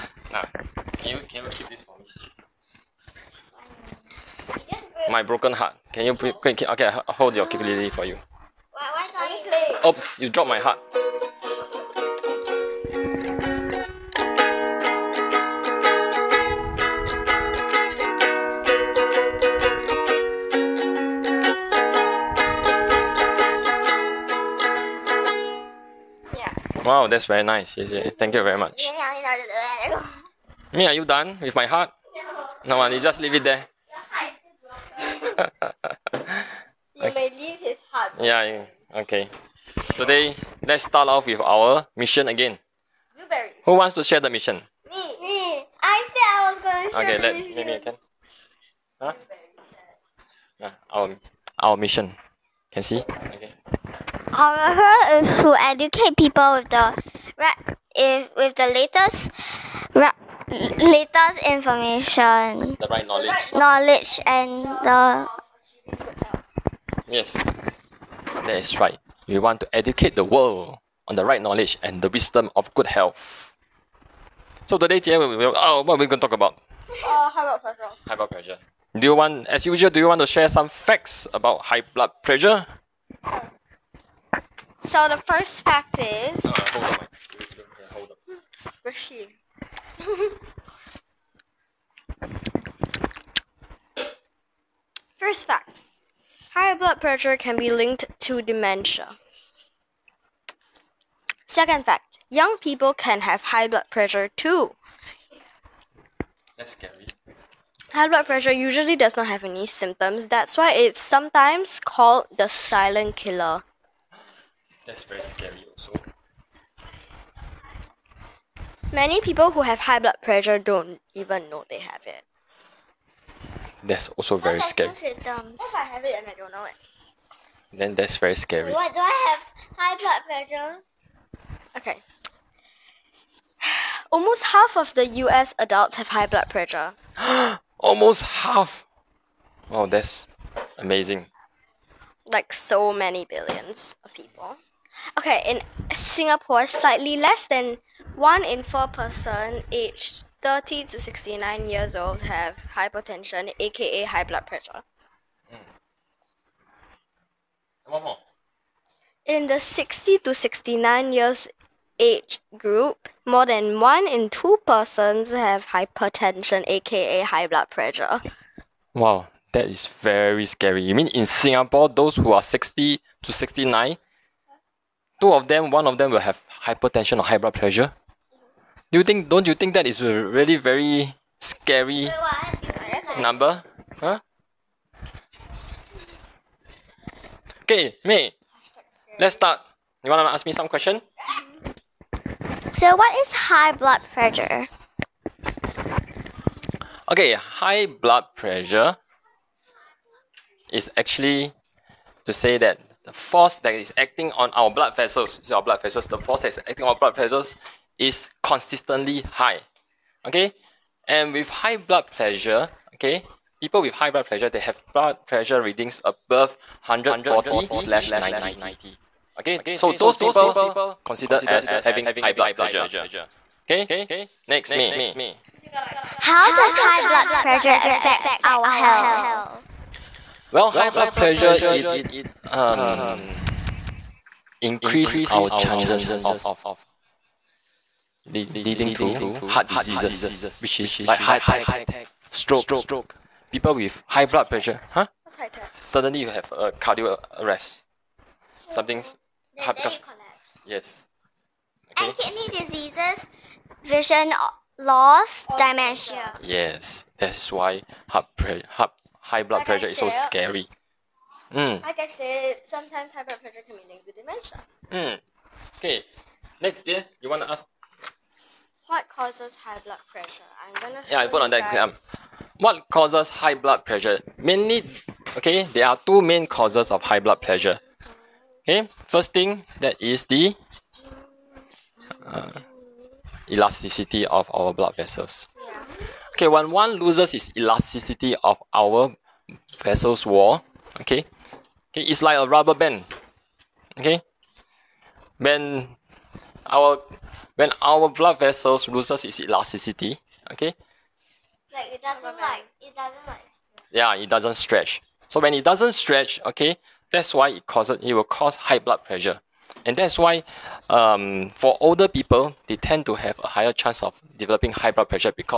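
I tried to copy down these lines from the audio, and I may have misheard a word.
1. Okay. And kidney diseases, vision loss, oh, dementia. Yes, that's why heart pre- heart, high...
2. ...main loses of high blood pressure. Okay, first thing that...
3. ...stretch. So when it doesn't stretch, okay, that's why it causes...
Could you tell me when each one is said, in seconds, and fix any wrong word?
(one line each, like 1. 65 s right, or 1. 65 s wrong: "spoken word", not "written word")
1. 251 s right
2. 276 s wrong: "causes", not "loses"
3. 304 s right.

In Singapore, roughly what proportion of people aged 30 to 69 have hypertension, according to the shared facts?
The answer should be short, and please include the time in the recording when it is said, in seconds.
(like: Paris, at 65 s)
slightly less than 1 in 4, at 148 s.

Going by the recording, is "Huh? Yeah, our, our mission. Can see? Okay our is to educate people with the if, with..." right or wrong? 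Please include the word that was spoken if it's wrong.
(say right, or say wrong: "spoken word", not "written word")
right.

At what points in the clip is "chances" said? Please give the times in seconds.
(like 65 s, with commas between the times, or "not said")
235 s, 313 s.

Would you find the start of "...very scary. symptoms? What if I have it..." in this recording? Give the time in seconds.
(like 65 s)
124 s.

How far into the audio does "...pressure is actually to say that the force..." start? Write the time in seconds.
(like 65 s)
198 s.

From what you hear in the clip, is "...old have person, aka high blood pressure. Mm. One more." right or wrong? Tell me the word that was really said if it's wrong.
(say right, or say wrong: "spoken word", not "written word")
wrong: "hypertension", not "person".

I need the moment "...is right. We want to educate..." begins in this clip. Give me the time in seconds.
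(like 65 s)
68 s.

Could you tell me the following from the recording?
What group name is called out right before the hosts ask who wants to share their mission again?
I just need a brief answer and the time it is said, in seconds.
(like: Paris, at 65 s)
Blueberries, at 43 s.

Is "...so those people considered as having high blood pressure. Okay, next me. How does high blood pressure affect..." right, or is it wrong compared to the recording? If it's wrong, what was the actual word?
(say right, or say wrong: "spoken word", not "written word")
right.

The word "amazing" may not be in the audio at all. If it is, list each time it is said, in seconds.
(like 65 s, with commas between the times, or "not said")
140 s.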